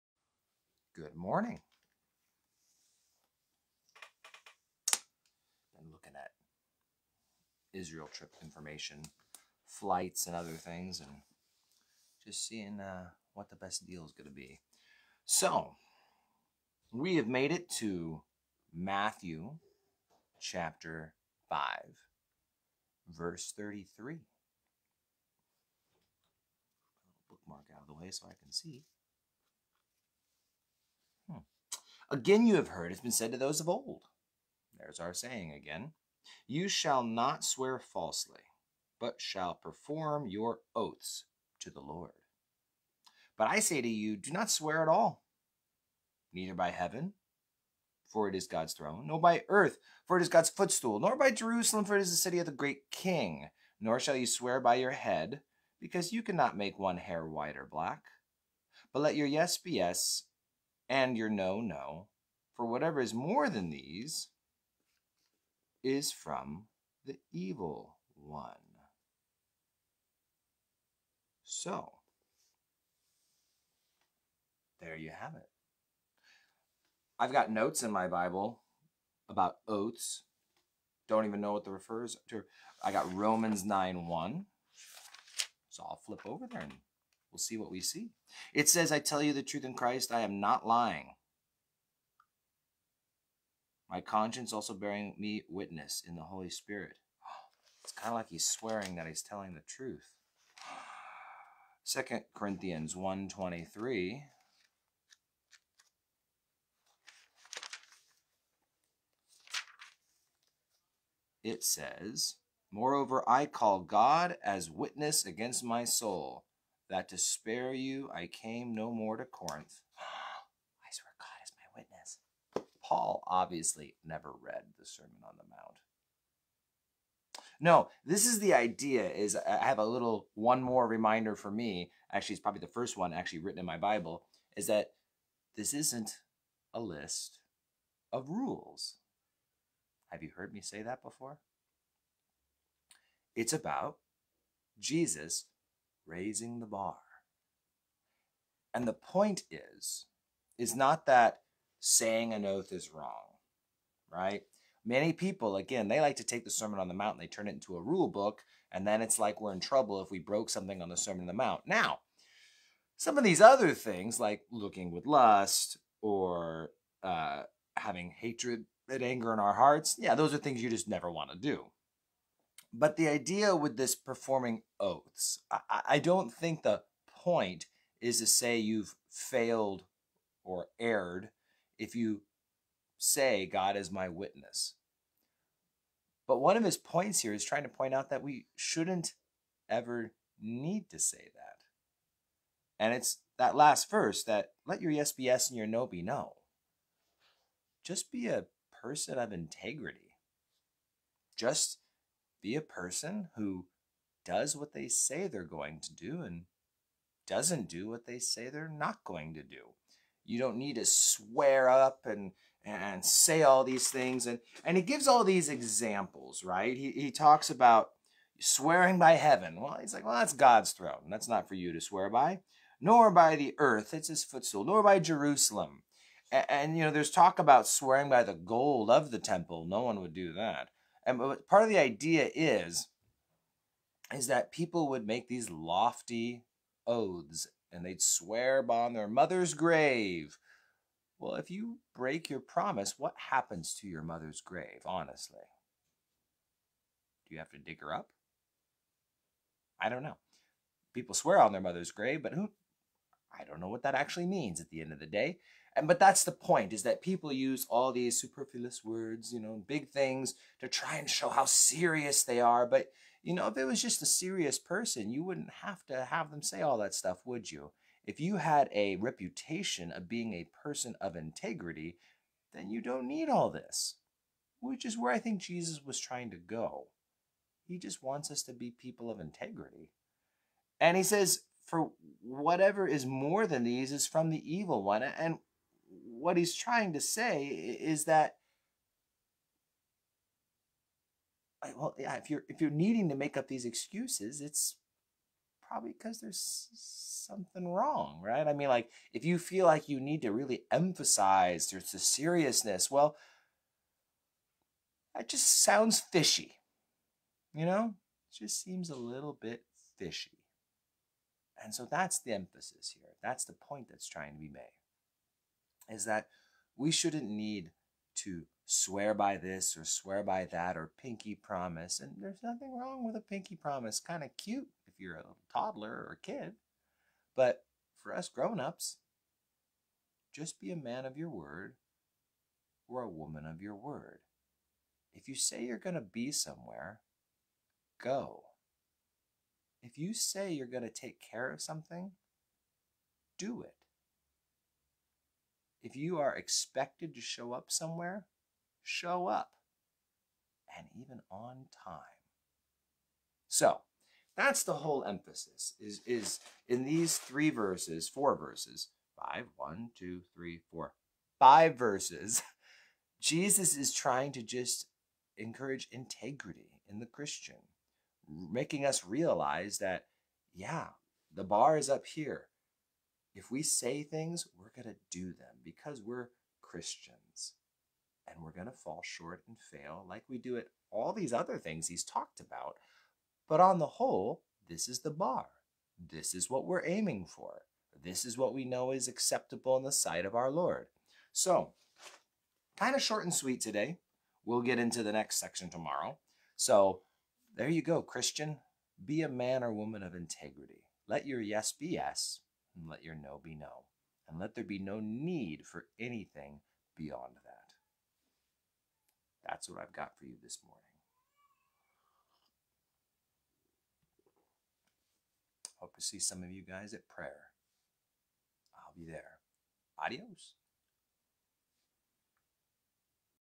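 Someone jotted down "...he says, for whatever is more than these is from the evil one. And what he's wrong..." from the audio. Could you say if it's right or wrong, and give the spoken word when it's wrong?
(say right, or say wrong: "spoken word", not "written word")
wrong: "trying", not "wrong".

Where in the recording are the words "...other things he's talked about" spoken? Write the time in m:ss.
6:21.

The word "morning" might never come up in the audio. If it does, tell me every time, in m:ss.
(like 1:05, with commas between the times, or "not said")
0:01, 6:50.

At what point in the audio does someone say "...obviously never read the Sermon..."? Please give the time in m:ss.
2:03.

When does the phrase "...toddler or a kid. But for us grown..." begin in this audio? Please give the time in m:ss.
5:25.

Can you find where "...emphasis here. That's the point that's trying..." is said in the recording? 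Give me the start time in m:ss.
5:12.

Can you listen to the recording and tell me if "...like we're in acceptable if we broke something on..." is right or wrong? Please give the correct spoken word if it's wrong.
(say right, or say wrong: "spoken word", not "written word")
wrong: "trouble", not "acceptable".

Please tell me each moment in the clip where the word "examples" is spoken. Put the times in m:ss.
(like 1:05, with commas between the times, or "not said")
3:35.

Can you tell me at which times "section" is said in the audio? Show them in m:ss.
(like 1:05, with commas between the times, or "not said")
6:35.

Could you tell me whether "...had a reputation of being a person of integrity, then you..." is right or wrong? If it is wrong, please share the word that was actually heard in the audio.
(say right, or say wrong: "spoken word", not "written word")
right.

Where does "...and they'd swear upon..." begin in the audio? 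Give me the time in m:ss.
3:57.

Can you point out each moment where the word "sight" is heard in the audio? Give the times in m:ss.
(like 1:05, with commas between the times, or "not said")
6:29.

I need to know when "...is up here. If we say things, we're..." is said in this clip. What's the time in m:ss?
6:11.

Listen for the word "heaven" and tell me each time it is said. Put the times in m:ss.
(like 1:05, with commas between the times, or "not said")
0:46, 3:39.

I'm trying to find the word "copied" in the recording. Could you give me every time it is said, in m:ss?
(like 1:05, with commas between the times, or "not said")
not said.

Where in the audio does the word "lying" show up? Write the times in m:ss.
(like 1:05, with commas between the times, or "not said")
1:30.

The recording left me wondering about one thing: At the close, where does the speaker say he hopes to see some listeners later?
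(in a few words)
prayer.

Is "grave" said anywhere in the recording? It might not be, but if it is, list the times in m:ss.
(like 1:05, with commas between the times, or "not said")
3:59, 4:04, 4:11.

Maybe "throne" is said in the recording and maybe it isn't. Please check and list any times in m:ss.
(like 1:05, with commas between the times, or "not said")
0:48, 3:40.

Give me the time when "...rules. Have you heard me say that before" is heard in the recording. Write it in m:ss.
2:18.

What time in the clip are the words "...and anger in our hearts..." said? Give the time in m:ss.
2:48.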